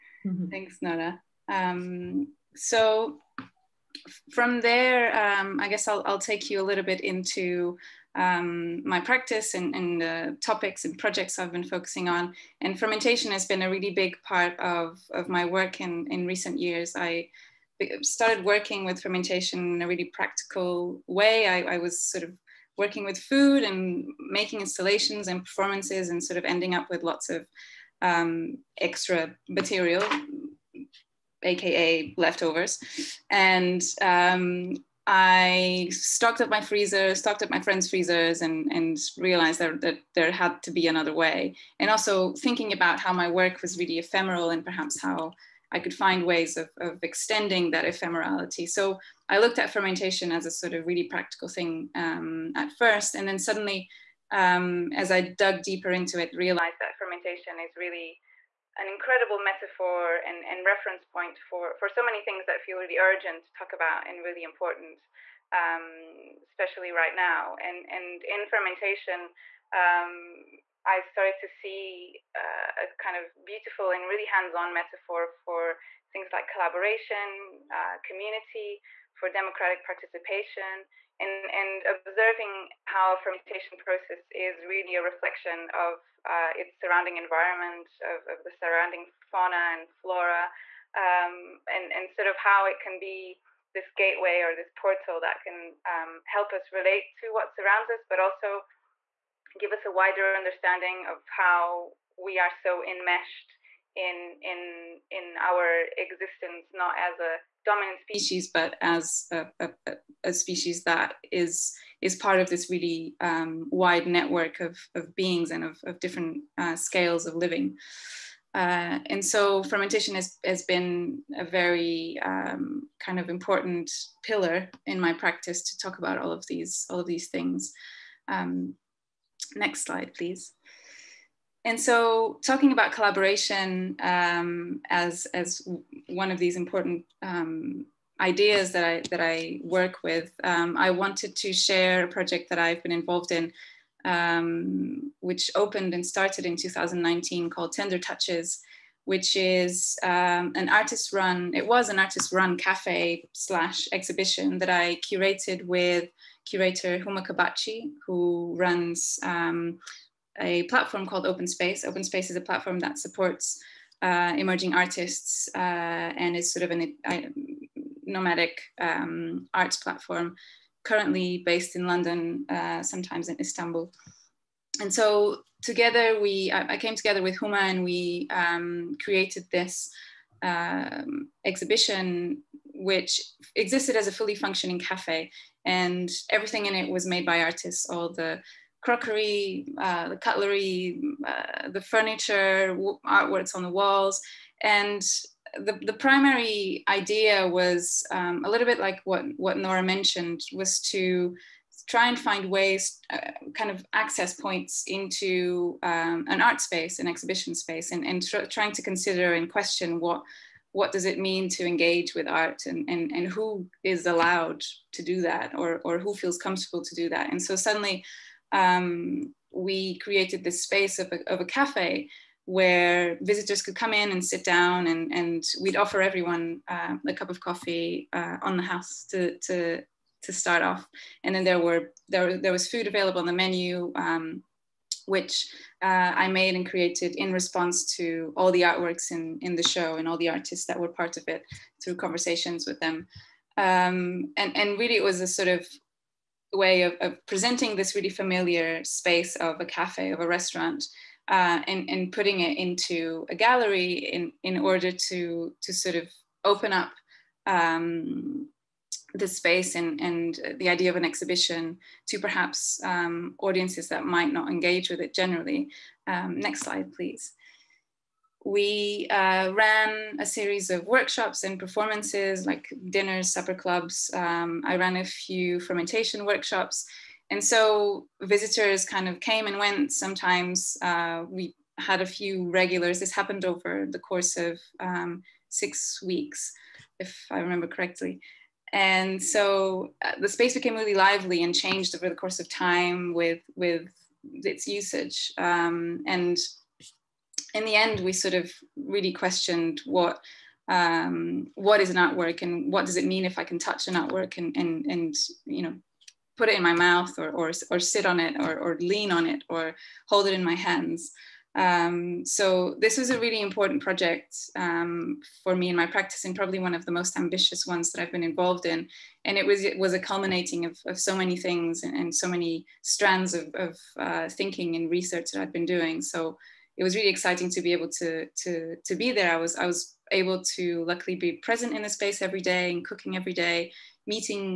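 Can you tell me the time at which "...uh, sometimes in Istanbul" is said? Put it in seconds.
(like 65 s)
172 s.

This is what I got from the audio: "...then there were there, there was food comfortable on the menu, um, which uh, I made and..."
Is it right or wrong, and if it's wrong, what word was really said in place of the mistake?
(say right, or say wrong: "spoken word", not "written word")
wrong: "available", not "comfortable".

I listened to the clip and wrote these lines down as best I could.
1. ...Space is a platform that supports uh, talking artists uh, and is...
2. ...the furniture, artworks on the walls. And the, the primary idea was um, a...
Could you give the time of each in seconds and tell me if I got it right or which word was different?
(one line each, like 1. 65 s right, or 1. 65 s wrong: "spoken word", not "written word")
1. 162 s wrong: "emerging", not "talking"
2. 191 s right.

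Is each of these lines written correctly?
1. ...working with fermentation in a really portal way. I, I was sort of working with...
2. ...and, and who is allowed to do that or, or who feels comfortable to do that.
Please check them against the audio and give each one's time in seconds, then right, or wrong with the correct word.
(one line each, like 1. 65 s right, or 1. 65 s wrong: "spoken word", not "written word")
1. 18 s wrong: "practical", not "portal"
2. 212 s right.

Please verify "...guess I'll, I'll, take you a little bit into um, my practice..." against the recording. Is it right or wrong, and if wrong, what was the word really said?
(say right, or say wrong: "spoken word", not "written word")
right.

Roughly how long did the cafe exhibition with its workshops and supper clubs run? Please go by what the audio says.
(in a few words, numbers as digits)
6 weeks.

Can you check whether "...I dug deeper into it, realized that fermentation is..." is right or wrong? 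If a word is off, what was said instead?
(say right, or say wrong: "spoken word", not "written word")
right.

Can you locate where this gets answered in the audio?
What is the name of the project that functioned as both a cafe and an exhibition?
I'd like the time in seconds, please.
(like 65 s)
147 s.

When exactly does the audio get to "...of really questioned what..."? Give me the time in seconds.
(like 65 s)
298 s.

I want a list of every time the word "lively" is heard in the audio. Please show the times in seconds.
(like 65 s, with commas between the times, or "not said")
290 s.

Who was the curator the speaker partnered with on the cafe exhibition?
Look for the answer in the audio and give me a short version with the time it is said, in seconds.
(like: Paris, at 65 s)
Huma Kabakci, at 156 s.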